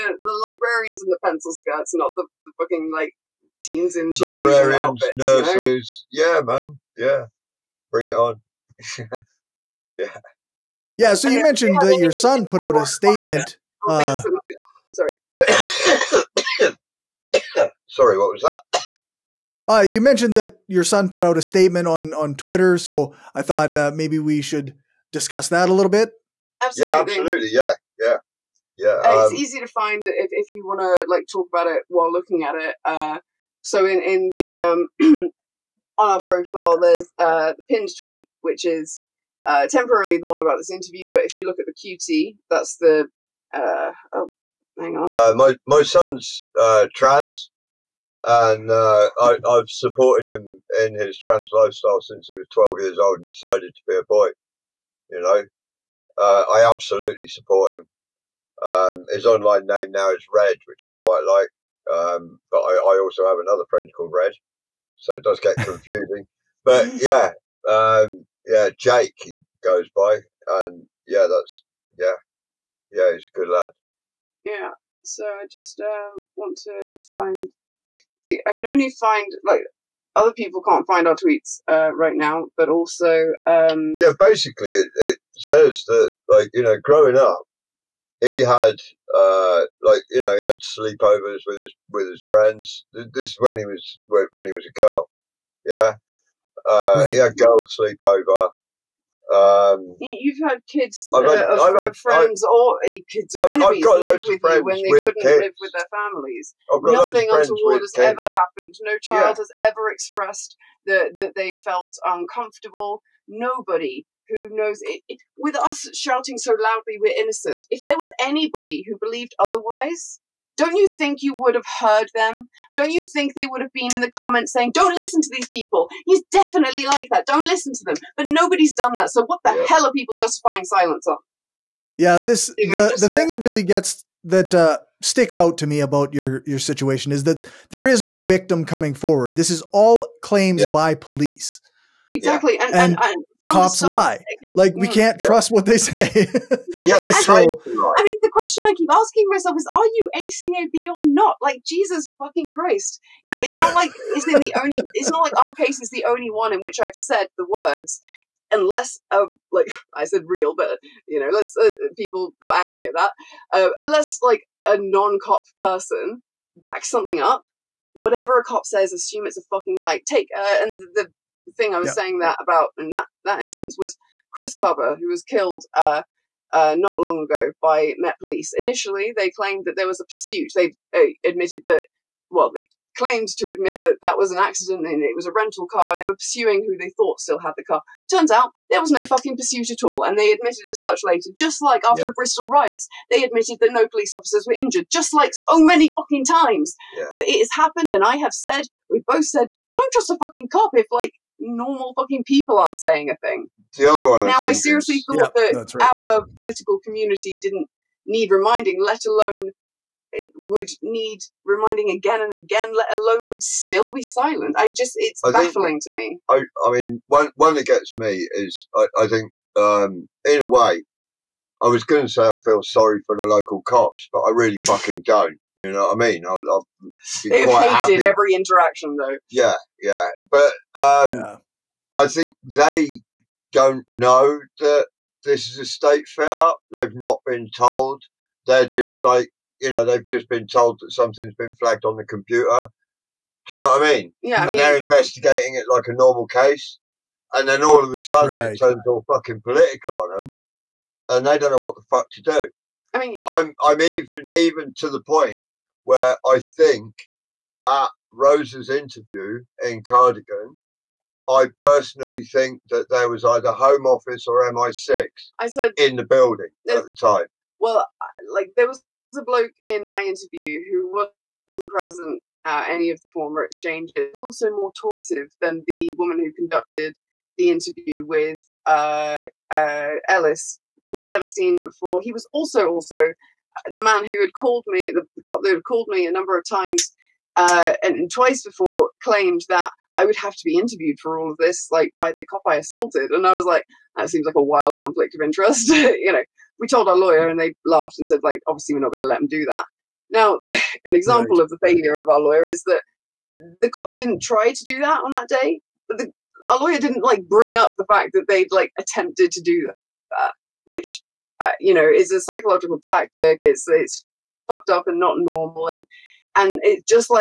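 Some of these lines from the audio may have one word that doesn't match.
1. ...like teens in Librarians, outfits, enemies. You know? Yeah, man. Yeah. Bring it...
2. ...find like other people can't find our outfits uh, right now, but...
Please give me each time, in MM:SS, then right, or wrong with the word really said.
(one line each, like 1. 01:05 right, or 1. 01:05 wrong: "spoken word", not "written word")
1. 00:02 wrong: "nurses", not "enemies"
2. 01:18 wrong: "tweets", not "outfits".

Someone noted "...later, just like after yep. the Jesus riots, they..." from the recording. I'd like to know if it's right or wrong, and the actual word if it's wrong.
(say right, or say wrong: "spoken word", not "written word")
wrong: "Bristol", not "Jesus".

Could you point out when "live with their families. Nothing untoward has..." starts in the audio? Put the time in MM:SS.
01:45.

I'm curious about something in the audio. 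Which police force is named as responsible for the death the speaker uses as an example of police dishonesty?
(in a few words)
Met Police.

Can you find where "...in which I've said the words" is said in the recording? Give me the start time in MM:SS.
02:36.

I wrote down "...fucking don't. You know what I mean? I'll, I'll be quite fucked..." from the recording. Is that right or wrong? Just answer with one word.
wrong.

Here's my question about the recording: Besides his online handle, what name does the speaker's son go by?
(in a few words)
Jake.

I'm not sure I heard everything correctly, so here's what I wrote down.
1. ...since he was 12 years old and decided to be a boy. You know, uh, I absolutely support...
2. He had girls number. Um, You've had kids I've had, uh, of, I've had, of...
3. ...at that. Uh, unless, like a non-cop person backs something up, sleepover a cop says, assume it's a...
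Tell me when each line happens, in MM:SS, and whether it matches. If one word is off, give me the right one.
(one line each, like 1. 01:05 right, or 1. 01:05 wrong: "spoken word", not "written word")
1. 00:52 right
2. 01:37 wrong: "sleepover", not "number"
3. 02:42 wrong: "whatever", not "sleepover".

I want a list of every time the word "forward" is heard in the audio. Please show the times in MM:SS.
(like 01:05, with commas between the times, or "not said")
02:18.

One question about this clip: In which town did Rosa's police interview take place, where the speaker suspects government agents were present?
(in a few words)
Cardigan.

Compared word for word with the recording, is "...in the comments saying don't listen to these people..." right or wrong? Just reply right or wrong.
right.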